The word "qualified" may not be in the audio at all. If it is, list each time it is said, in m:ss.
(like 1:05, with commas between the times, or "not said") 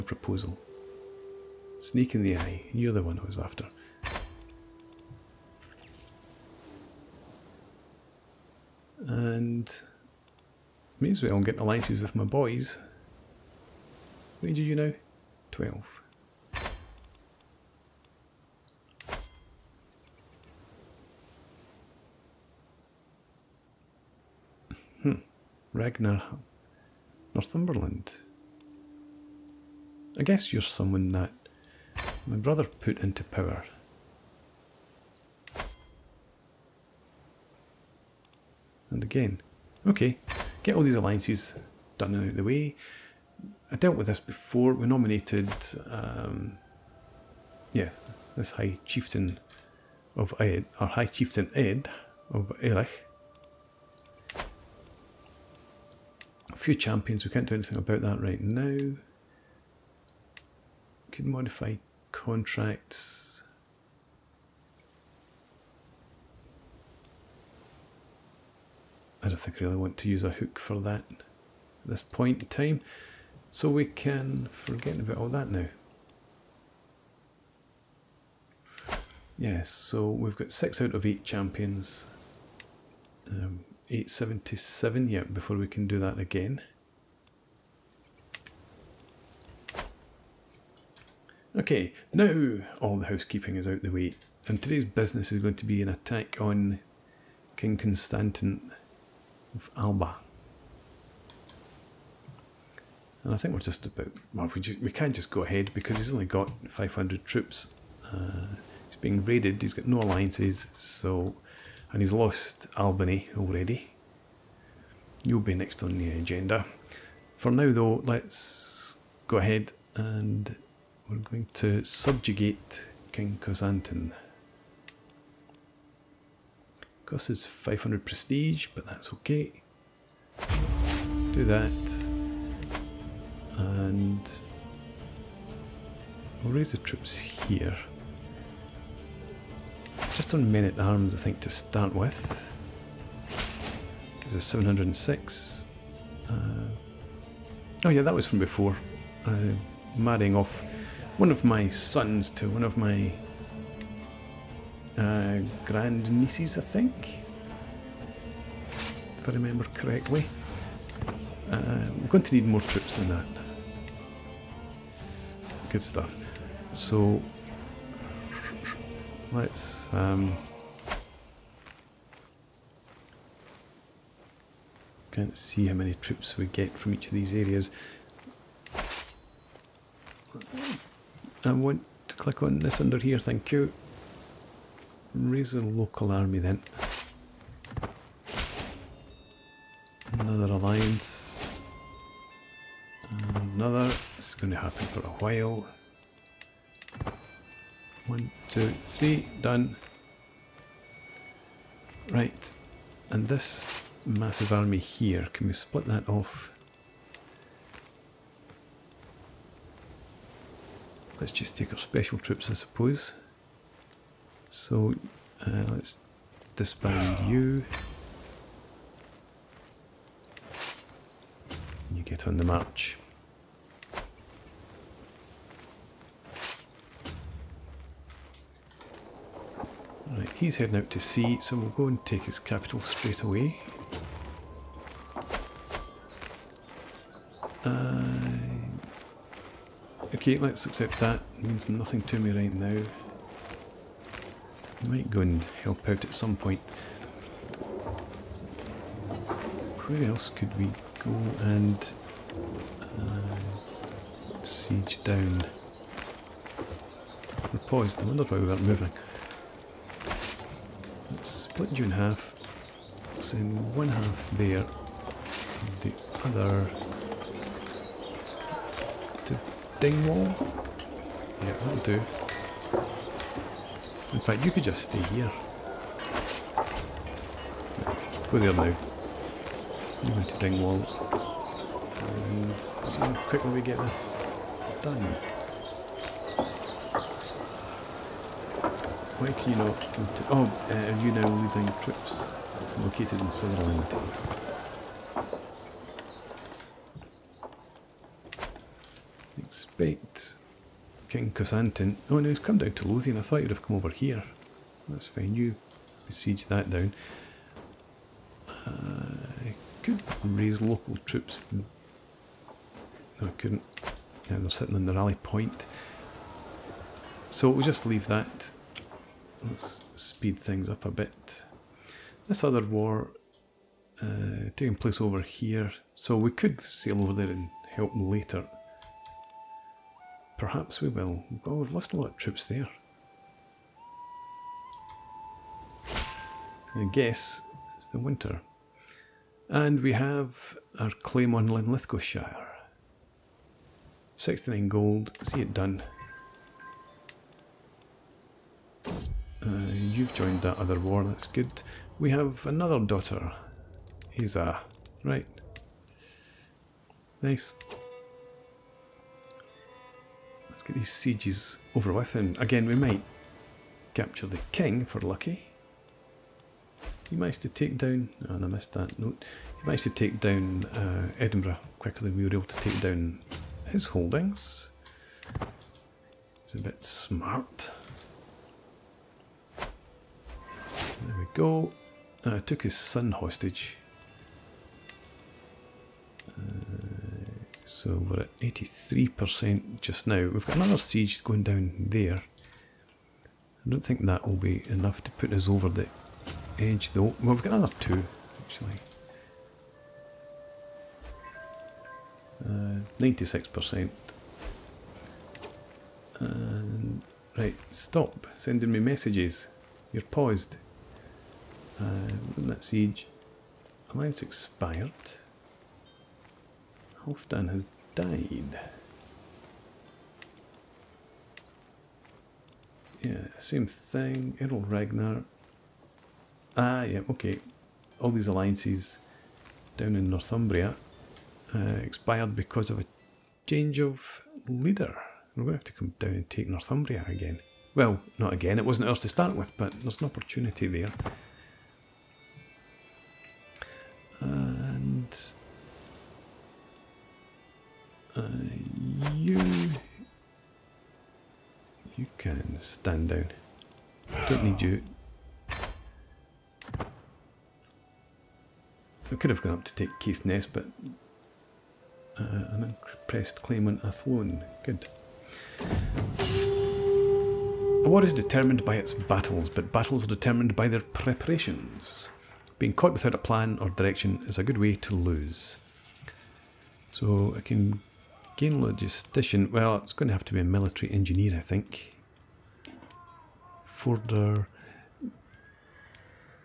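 not said.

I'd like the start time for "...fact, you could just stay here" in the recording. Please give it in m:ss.
4:34.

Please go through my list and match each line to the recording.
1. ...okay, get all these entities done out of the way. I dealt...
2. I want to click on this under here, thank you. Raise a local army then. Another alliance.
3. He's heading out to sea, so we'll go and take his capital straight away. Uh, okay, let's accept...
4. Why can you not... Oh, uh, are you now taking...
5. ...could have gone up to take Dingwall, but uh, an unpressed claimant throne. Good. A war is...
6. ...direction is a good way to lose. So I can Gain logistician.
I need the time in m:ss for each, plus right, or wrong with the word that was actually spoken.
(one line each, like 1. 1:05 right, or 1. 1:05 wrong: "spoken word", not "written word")
1. 0:39 wrong: "alliances", not "entities"
2. 3:01 right
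3. 3:50 right
4. 4:49 wrong: "leading", not "taking"
5. 7:39 wrong: "Caithness", not "Dingwall"
6. 7:53 right.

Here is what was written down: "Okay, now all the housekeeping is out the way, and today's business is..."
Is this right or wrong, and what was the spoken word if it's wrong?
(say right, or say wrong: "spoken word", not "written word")
right.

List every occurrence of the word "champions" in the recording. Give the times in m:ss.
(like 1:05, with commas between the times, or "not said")
0:56, 1:21.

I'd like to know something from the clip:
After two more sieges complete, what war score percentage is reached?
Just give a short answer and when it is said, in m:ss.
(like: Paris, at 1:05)
96%, at 6:42.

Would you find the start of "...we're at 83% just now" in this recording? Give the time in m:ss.
6:28.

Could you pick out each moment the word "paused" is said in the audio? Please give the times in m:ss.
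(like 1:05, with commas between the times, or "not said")
4:17, 6:50.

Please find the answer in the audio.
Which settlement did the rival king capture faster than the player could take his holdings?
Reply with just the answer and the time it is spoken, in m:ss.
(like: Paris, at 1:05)
Edinburgh, at 6:11.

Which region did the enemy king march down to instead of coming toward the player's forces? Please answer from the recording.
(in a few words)
Lothian.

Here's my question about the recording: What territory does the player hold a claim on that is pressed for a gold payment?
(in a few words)
Linlithgowshire.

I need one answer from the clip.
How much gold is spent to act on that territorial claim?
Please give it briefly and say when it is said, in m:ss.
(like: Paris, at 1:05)
69 gold, at 5:44.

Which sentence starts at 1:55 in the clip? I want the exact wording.
You'll be next on the agenda.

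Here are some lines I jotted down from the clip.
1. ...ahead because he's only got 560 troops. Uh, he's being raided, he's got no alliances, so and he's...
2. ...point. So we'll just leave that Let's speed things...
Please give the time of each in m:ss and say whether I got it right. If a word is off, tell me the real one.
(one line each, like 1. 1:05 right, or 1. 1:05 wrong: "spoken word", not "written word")
1. 1:45 wrong: "500", not "560"
2. 5:15 right.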